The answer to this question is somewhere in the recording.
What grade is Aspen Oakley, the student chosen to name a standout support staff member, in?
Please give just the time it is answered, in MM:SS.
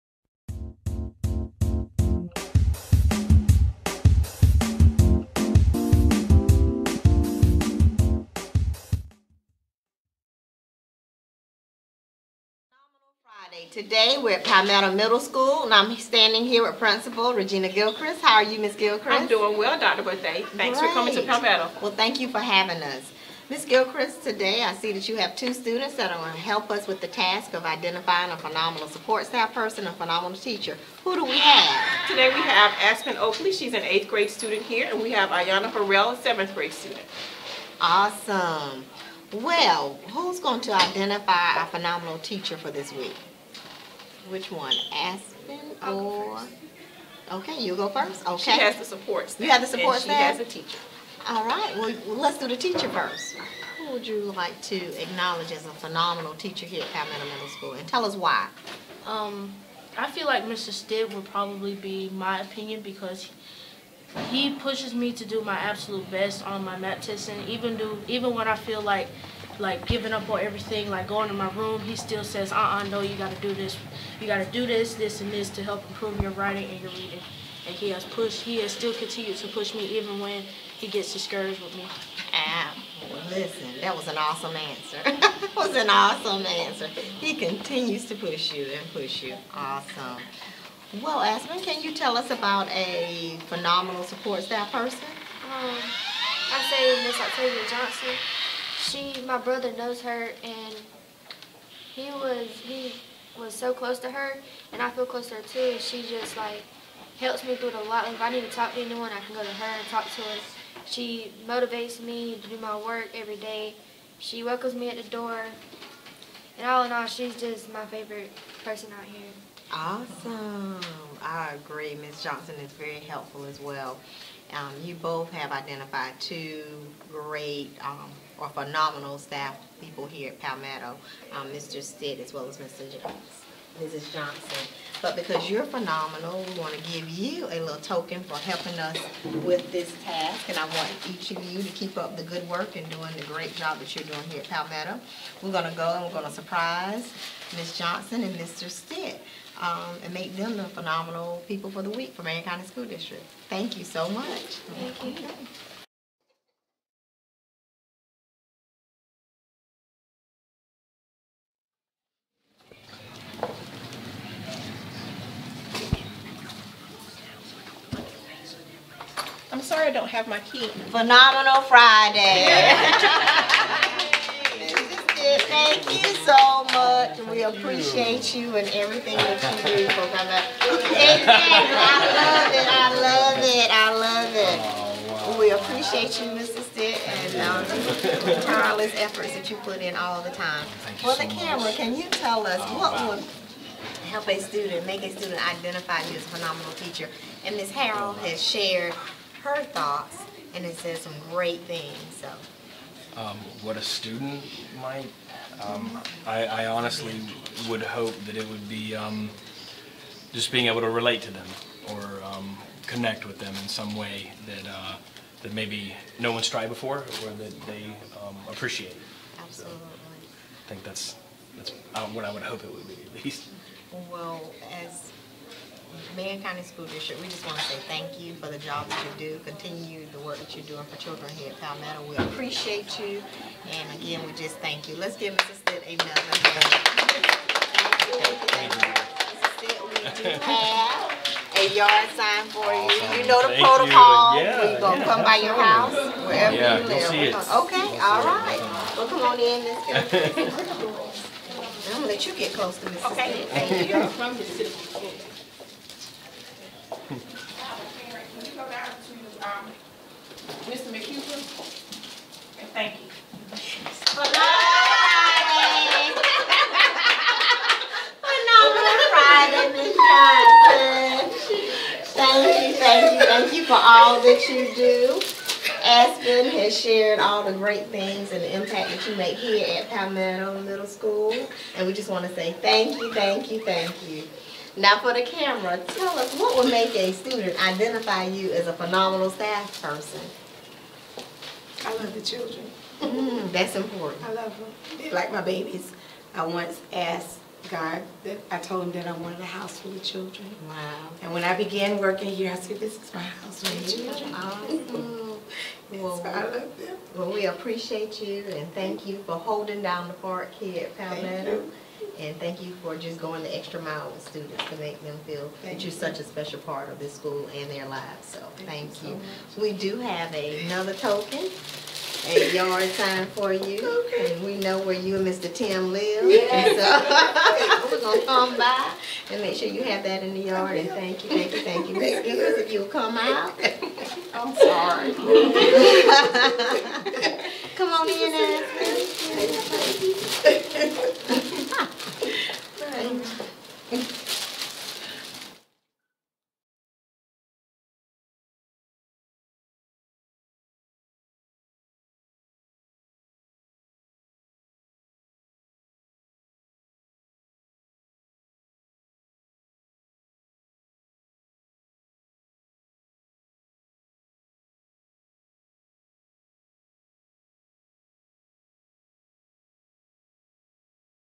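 00:33.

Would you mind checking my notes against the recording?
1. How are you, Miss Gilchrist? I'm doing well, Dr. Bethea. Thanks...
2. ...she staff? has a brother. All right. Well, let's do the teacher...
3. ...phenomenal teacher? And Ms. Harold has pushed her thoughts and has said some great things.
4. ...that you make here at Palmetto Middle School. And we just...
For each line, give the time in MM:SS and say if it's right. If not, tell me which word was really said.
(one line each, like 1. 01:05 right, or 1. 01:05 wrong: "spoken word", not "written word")
1. 00:18 right
2. 00:50 wrong: "teacher", not "brother"
3. 03:16 wrong: "shared", not "pushed"
4. 04:38 right.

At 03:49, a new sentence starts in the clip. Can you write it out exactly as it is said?
Continue the work that you're doing for children here at Palmetto.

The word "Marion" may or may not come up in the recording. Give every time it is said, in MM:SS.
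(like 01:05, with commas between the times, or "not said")
02:32, 03:46.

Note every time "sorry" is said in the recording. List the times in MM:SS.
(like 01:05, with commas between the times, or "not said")
02:49, 05:36.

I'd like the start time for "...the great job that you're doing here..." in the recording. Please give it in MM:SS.
02:23.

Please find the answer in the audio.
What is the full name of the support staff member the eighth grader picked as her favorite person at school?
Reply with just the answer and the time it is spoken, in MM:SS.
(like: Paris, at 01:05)
Octavia Johnson, at 01:37.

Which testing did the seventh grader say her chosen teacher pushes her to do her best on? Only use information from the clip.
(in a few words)
MAP testing.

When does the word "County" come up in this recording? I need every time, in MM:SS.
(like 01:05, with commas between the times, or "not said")
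02:32, 03:46.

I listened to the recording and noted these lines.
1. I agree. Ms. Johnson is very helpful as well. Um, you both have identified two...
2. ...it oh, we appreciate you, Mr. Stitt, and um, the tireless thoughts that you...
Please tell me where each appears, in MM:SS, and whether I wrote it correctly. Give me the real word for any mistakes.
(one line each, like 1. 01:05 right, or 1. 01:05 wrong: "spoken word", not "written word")
1. 02:01 right
2. 03:04 wrong: "efforts", not "thoughts".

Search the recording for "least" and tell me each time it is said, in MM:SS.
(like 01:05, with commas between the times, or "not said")
03:43.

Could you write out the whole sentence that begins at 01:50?
She motivates me to do my work every day.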